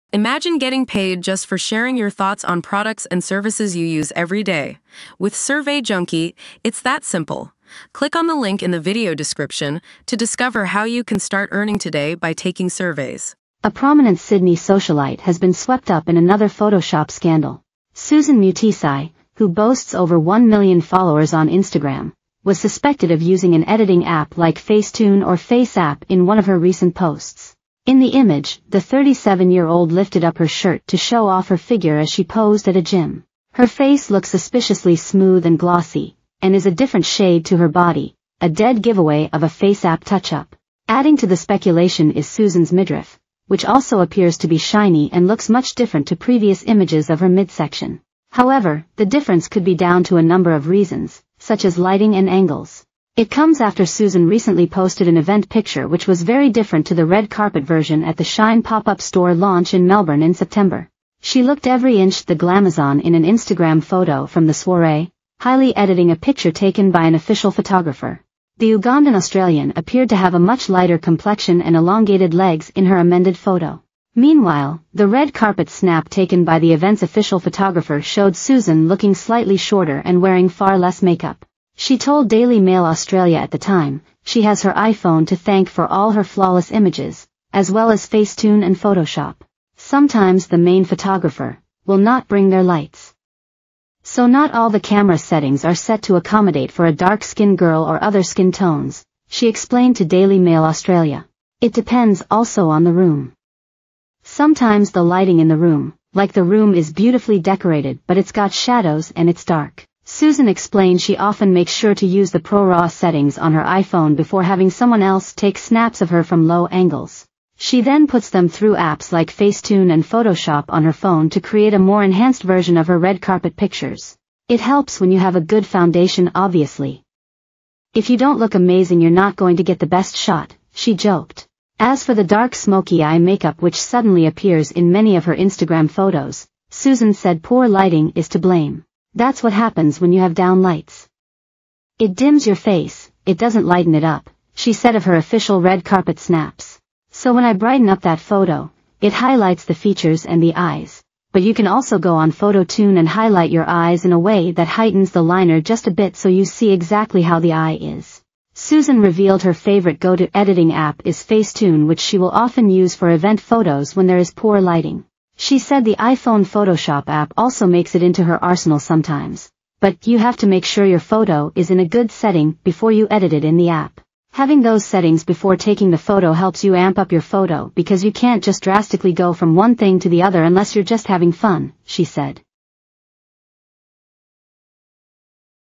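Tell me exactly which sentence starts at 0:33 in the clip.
Her face looks suspiciously smooth and glossy, and is a different shade to her body, a dead giveaway of a face-app touch-up.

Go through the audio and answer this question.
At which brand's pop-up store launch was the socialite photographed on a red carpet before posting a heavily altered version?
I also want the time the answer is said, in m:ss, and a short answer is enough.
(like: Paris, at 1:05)
Shine, at 0:58.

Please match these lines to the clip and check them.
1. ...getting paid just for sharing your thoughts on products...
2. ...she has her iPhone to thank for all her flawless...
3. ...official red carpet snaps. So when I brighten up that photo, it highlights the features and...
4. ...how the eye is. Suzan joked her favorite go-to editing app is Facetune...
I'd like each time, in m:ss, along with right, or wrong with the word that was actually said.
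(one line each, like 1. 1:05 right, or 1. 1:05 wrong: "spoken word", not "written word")
1. 0:00 right
2. 1:24 right
3. 2:25 right
4. 2:37 wrong: "revealed", not "joked".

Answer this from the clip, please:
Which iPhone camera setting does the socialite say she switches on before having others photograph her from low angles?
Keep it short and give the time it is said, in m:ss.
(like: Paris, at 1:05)
ProRAW, at 1:52.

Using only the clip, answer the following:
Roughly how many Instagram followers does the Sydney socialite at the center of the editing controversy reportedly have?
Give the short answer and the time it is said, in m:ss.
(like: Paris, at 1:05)
over 1 million, at 0:19.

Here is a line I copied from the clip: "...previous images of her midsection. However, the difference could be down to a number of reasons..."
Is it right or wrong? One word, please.
right.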